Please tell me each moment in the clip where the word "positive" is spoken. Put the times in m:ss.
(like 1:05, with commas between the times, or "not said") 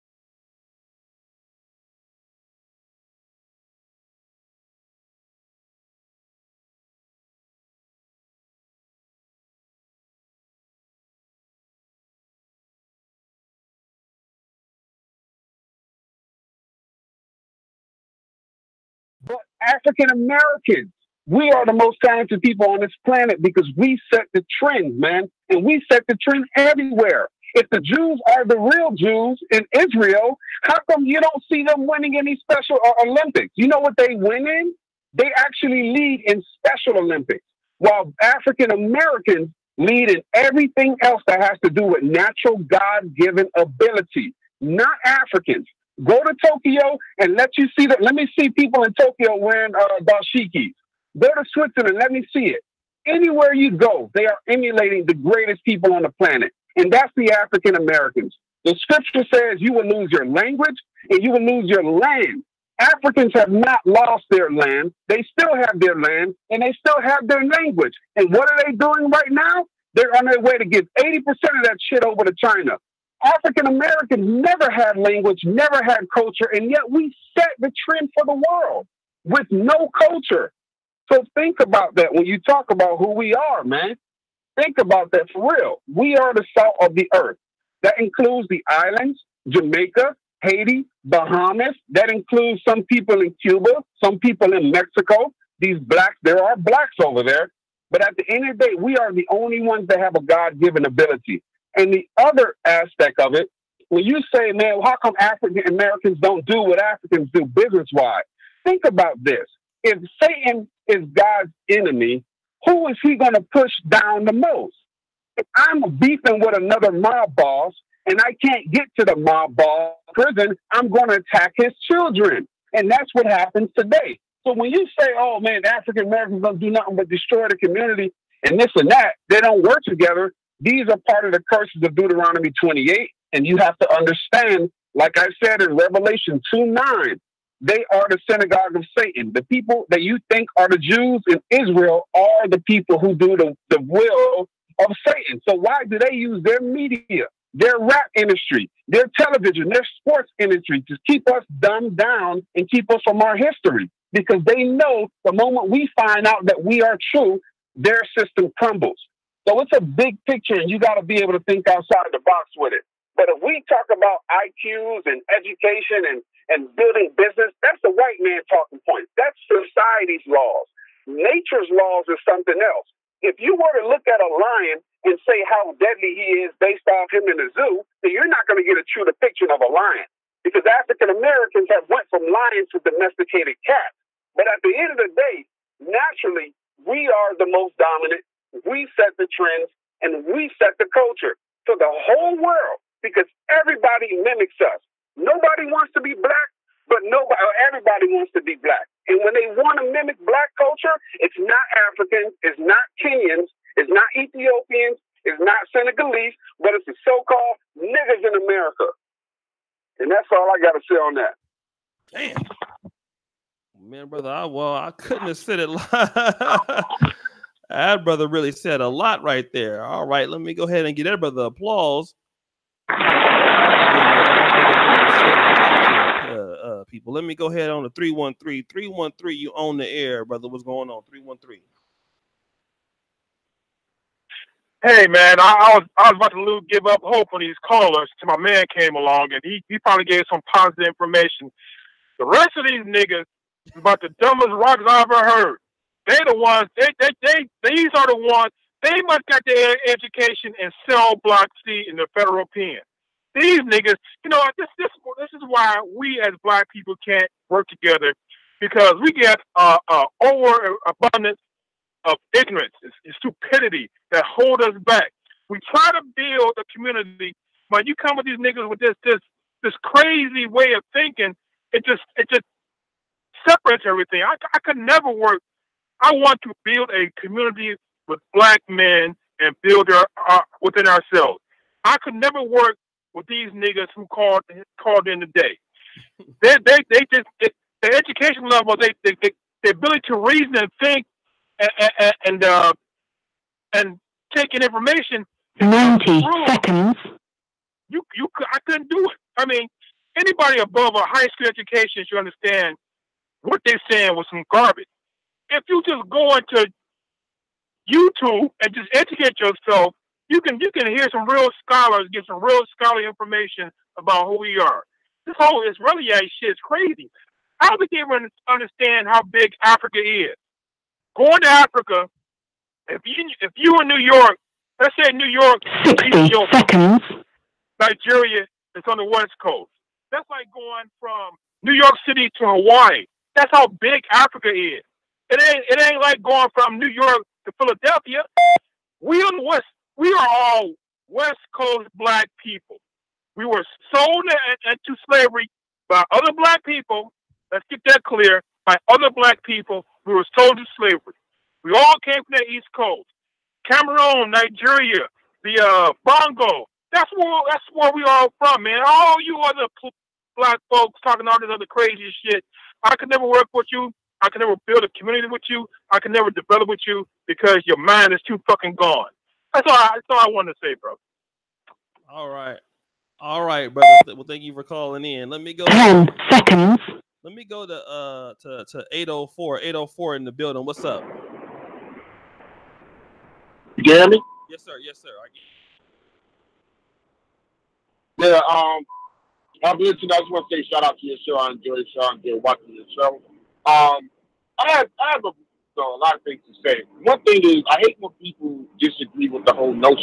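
4:00.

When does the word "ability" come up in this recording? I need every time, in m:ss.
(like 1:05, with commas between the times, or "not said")
0:43, 1:40, 4:49.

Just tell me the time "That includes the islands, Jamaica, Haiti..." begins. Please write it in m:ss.
1:27.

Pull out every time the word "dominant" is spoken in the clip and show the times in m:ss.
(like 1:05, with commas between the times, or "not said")
3:07.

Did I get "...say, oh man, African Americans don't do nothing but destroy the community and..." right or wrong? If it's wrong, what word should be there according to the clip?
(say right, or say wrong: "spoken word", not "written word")
right.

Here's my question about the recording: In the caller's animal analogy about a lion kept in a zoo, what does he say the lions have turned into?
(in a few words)
domesticated cats.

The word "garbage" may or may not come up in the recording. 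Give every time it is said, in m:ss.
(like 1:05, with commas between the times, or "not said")
5:04.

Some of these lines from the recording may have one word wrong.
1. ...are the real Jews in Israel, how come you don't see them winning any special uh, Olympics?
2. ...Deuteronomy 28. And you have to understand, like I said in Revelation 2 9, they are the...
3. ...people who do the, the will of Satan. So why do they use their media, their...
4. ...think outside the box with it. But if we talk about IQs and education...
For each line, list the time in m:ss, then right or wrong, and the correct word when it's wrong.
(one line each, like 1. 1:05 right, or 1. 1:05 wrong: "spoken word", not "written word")
1. 0:28 right
2. 2:11 right
3. 2:22 right
4. 2:41 right.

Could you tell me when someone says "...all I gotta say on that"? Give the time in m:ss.
3:30.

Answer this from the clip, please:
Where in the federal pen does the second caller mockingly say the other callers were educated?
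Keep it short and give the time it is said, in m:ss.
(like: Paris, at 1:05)
cell block C, at 4:10.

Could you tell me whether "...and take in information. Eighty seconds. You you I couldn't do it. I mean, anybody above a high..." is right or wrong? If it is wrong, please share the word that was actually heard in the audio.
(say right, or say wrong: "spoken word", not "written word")
wrong: "Ninety", not "Eighty".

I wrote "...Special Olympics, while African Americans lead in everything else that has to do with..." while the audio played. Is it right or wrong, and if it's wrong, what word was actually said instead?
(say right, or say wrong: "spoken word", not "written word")
right.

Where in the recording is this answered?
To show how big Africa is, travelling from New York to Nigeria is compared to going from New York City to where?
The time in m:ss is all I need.
5:32.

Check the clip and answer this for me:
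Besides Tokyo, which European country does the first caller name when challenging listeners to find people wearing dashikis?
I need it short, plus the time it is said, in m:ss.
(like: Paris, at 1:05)
Switzerland, at 0:51.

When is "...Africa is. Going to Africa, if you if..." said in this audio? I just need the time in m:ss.
5:19.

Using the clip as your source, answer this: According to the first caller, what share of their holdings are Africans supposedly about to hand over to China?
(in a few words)
80%.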